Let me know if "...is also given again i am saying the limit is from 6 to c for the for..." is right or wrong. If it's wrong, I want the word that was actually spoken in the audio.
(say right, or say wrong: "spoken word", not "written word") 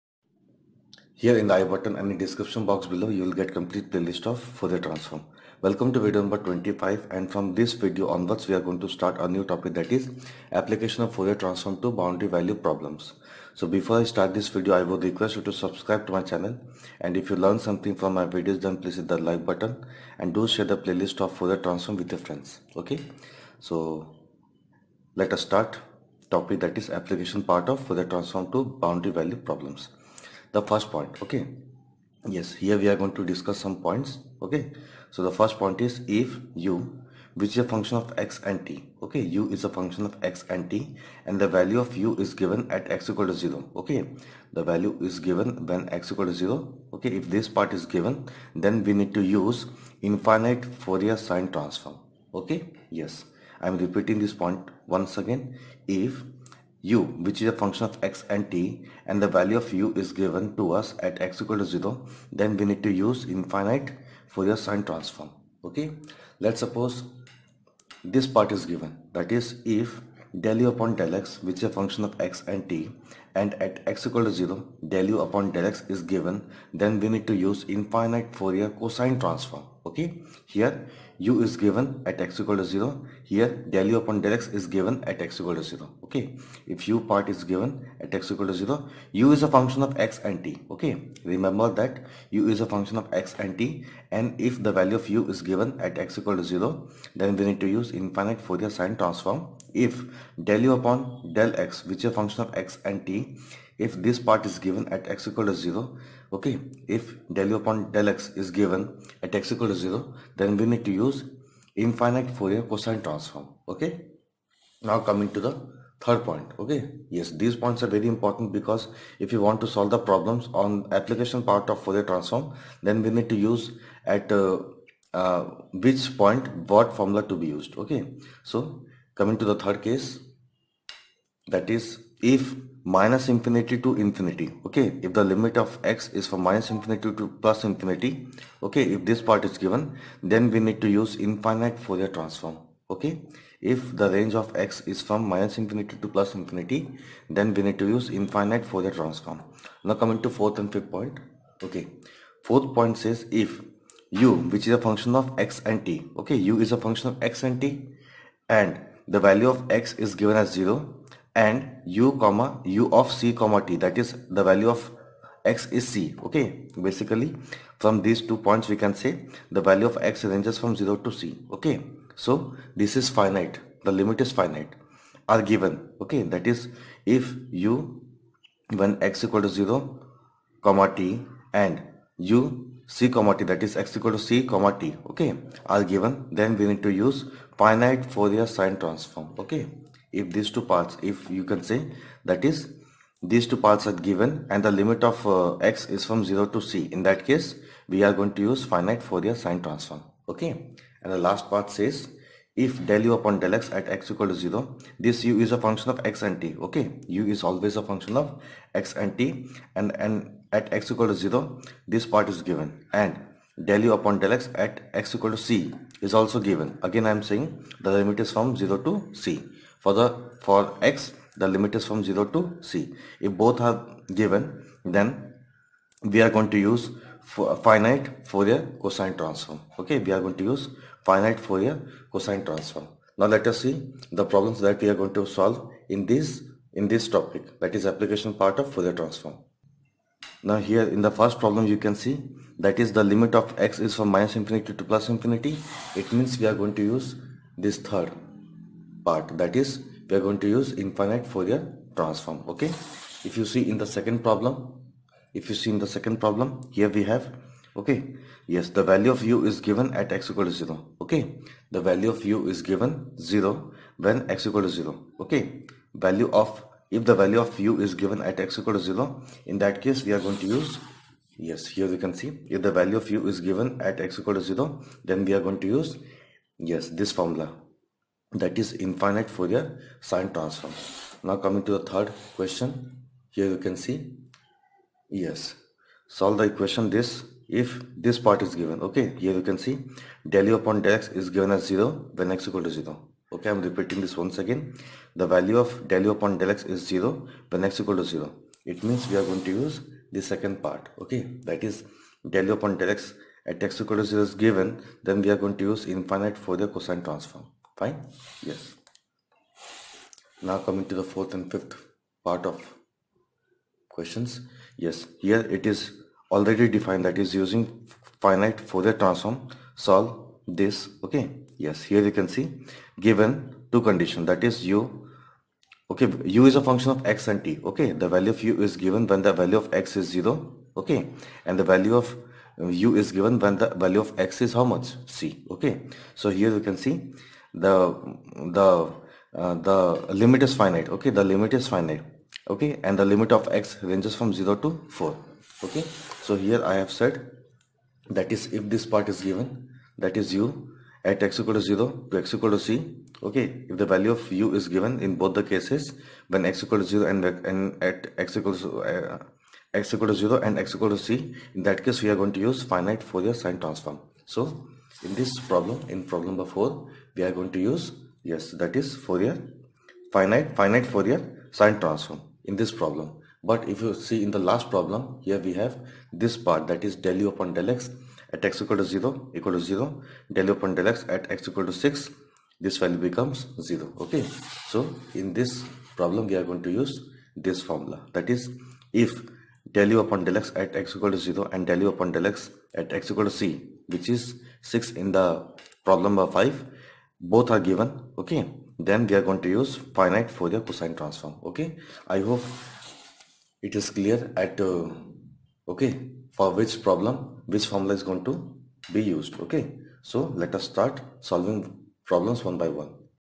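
wrong: "0", not "6".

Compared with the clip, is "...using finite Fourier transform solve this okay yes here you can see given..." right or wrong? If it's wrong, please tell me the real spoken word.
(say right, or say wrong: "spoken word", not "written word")
right.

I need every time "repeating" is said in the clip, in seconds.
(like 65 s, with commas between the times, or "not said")
53 s, 293 s.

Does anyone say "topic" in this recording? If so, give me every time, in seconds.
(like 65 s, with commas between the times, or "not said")
9 s, 26 s, 237 s.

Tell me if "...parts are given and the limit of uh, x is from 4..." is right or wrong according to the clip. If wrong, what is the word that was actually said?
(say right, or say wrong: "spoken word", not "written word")
wrong: "0", not "4".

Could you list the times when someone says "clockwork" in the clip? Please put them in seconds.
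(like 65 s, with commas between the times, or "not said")
not said.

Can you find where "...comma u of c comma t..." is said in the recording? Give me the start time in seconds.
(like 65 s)
162 s.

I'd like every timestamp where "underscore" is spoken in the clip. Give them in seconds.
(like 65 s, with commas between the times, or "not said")
not said.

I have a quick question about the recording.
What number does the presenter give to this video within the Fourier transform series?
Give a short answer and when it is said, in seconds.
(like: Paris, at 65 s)
25, at 5 s.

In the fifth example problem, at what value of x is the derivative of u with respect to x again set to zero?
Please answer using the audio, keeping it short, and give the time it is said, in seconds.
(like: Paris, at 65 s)
6, at 381 s.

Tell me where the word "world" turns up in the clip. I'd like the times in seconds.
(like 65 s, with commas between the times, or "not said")
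not said.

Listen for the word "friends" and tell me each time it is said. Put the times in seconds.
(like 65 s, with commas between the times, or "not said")
22 s.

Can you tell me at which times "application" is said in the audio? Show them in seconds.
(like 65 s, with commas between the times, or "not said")
10 s, 26 s, 120 s, 237 s.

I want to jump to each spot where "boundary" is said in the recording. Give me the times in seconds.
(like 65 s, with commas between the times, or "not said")
11 s, 28 s.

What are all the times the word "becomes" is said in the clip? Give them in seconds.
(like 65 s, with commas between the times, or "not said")
383 s.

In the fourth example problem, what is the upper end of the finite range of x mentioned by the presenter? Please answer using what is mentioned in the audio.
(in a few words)
4.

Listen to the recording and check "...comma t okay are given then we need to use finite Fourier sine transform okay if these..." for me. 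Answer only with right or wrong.
right.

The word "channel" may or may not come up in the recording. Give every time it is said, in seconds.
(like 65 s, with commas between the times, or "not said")
16 s.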